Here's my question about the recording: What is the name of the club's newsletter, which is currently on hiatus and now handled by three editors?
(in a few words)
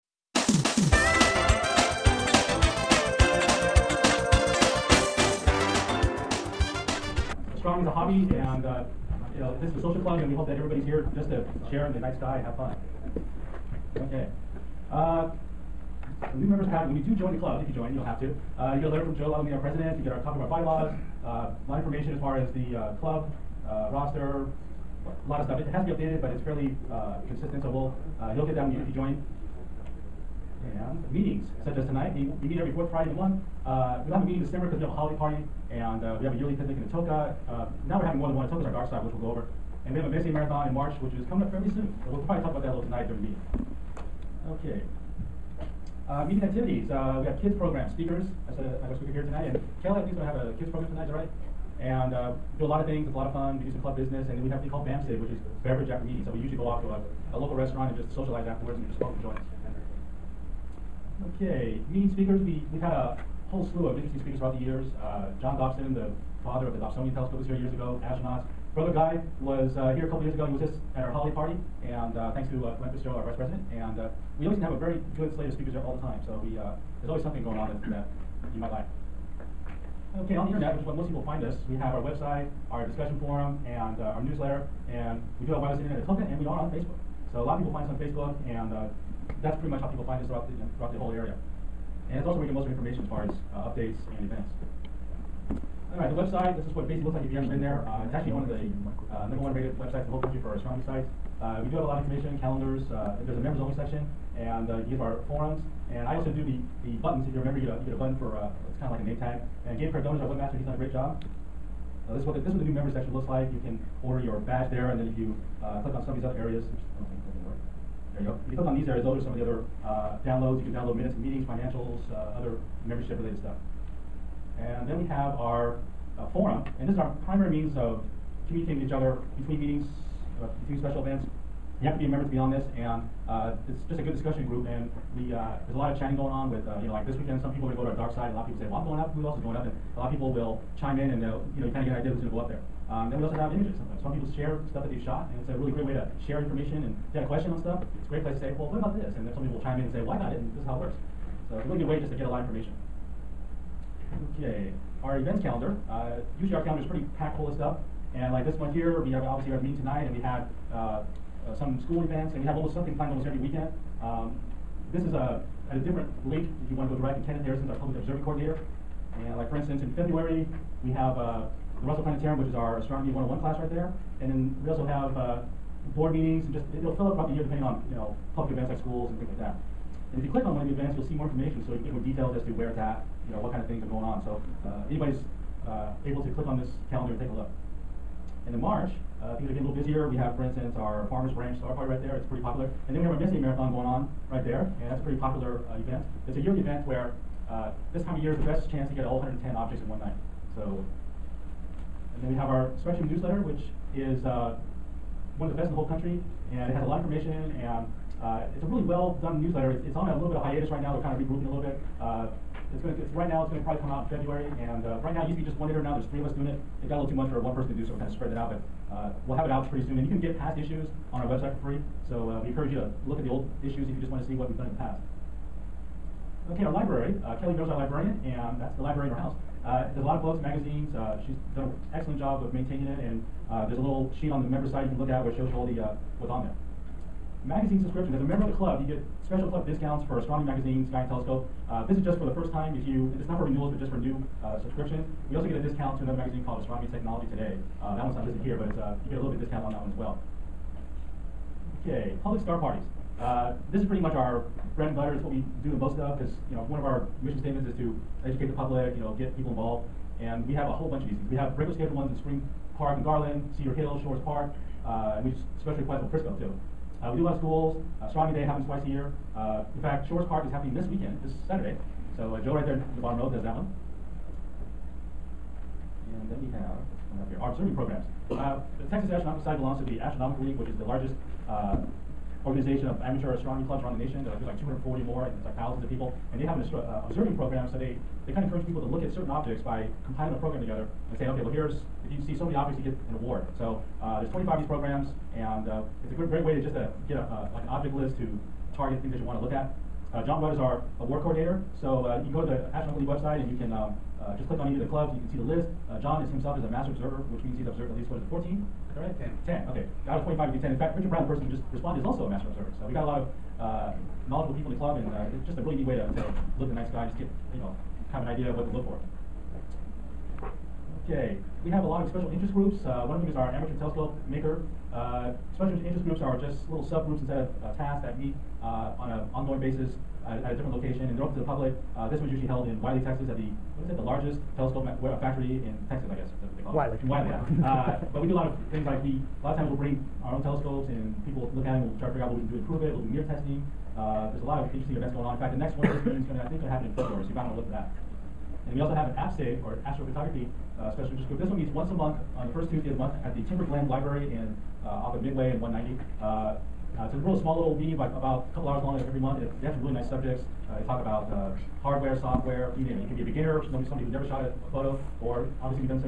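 Spectrum.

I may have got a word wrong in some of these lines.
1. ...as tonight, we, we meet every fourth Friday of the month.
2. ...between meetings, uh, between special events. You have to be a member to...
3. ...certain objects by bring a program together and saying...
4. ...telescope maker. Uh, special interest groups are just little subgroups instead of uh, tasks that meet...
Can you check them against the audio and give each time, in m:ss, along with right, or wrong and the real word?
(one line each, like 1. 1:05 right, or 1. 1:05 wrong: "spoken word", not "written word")
1. 0:31 right
2. 2:09 right
3. 4:49 wrong: "compiling", not "bring"
4. 5:23 right.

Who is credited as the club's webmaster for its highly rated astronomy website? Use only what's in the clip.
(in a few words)
Gabe Cardona.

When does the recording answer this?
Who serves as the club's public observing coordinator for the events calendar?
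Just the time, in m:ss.
2:47.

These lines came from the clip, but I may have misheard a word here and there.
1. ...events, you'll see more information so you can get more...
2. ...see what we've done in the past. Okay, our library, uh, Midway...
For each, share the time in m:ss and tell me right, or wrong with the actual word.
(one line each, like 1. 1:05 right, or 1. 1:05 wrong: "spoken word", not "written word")
1. 3:00 right
2. 3:44 wrong: "Kelly", not "Midway".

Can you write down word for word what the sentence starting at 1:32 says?
And it's also where you get most of your information as far as uh, updates and events.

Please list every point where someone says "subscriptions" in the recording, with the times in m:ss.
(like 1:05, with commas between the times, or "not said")
3:57, 4:04.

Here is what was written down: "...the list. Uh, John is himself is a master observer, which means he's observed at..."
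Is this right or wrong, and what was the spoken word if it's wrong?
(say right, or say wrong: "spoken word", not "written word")
right.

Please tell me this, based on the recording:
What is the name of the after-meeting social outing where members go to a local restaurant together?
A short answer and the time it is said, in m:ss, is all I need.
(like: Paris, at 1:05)
BAMSIG, at 0:54.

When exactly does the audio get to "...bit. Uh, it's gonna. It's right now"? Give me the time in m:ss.
3:31.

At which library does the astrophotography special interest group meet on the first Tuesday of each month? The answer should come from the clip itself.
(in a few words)
Timberglen Library.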